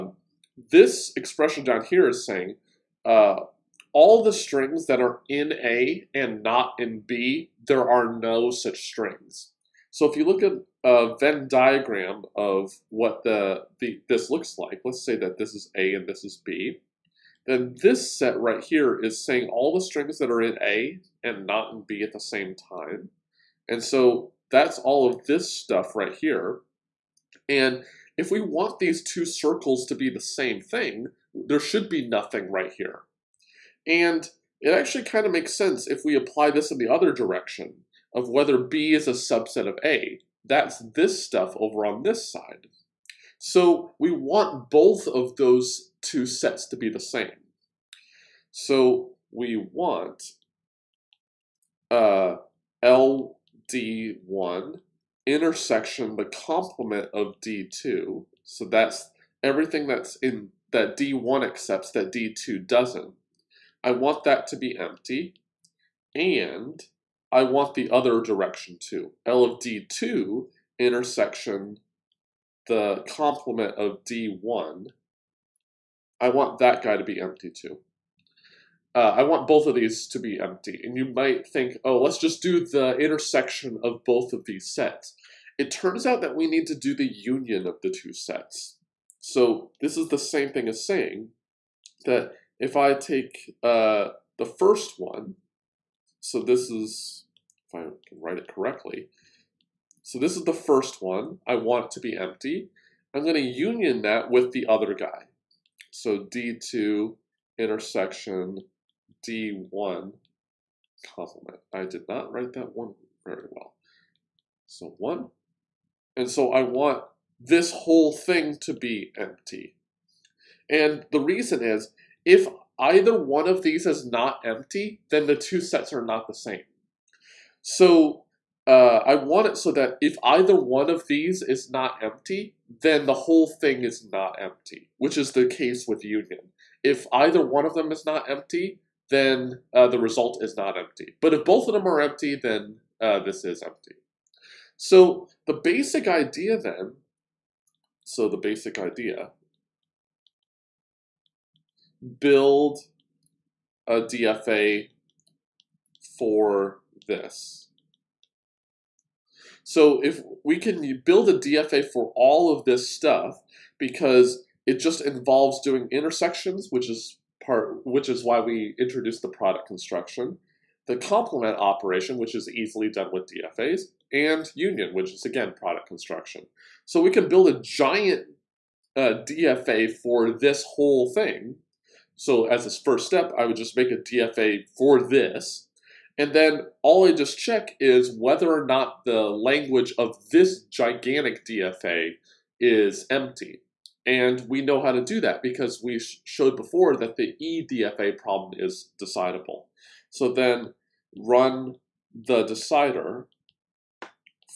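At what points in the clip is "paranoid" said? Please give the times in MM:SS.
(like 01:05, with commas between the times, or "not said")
not said.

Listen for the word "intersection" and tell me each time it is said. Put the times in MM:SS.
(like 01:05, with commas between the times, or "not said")
00:55, 01:10, 01:22, 01:47, 02:45.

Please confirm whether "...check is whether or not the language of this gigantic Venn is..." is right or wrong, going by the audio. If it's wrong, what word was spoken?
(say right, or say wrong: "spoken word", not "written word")
wrong: "DFA", not "Venn".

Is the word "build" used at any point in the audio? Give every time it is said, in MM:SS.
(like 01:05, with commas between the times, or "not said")
02:32, 02:41, 02:57.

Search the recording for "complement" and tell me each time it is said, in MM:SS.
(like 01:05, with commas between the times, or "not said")
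00:56, 01:13, 01:51, 02:50.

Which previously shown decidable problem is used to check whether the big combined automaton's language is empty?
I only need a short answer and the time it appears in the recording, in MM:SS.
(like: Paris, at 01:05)
EDFA, at 03:17.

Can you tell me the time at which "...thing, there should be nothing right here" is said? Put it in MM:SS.
00:30.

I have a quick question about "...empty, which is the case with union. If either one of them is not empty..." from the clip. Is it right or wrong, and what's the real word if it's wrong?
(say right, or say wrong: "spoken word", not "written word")
right.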